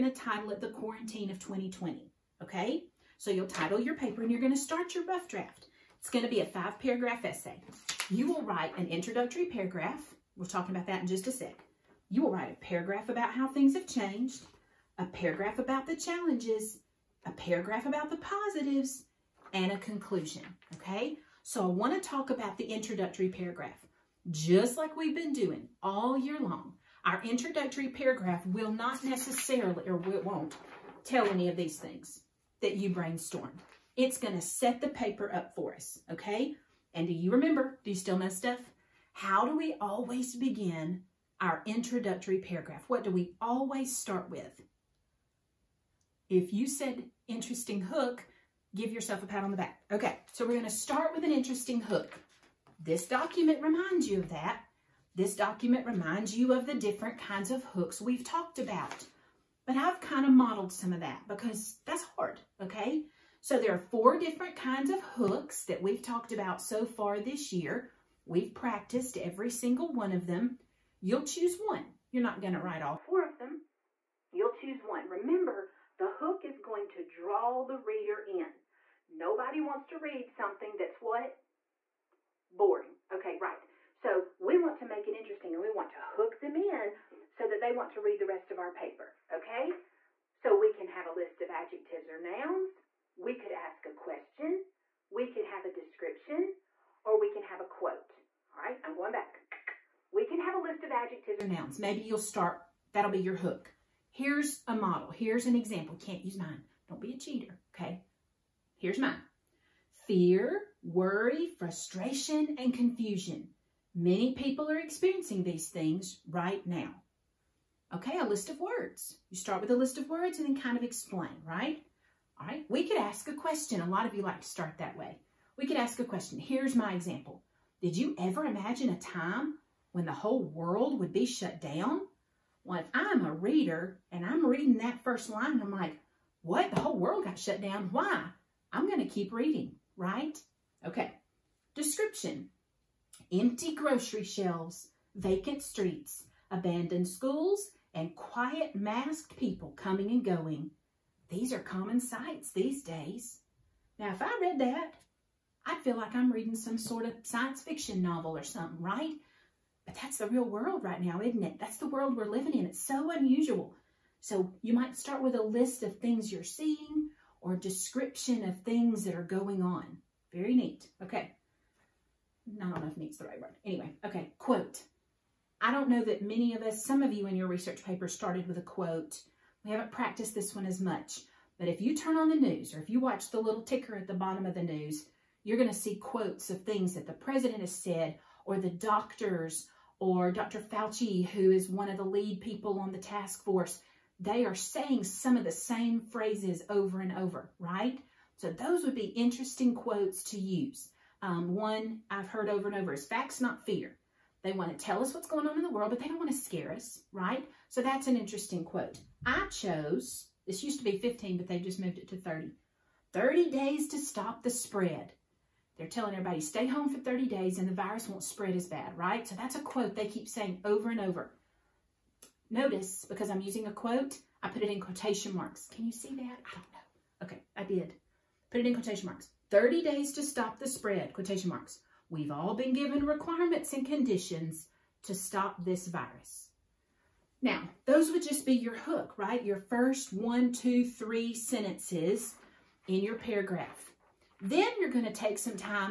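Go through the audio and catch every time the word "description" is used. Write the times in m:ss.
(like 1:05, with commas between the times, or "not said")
1:35, 2:21, 2:47.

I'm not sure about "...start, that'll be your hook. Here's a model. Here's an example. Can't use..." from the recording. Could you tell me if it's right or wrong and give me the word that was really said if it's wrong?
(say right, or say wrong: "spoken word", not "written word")
right.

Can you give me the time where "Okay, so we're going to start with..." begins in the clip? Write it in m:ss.
0:49.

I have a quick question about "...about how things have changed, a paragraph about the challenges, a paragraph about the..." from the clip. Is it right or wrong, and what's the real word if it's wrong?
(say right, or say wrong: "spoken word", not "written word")
right.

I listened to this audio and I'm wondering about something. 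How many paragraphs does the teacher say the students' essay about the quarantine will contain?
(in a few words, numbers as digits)
5.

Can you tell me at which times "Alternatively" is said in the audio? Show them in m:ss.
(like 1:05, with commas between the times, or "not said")
not said.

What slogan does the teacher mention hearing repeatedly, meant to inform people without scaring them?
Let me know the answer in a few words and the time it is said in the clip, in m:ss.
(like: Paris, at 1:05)
facts, not fear, at 3:23.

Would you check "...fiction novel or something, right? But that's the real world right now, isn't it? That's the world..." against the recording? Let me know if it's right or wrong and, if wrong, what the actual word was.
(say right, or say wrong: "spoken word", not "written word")
right.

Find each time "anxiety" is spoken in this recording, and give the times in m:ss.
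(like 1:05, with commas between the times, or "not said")
not said.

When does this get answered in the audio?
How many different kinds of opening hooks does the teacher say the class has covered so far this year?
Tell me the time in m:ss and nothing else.
1:03.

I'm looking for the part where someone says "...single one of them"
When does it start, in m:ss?
1:09.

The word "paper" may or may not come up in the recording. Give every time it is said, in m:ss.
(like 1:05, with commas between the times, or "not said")
0:03, 0:34, 1:28, 2:57.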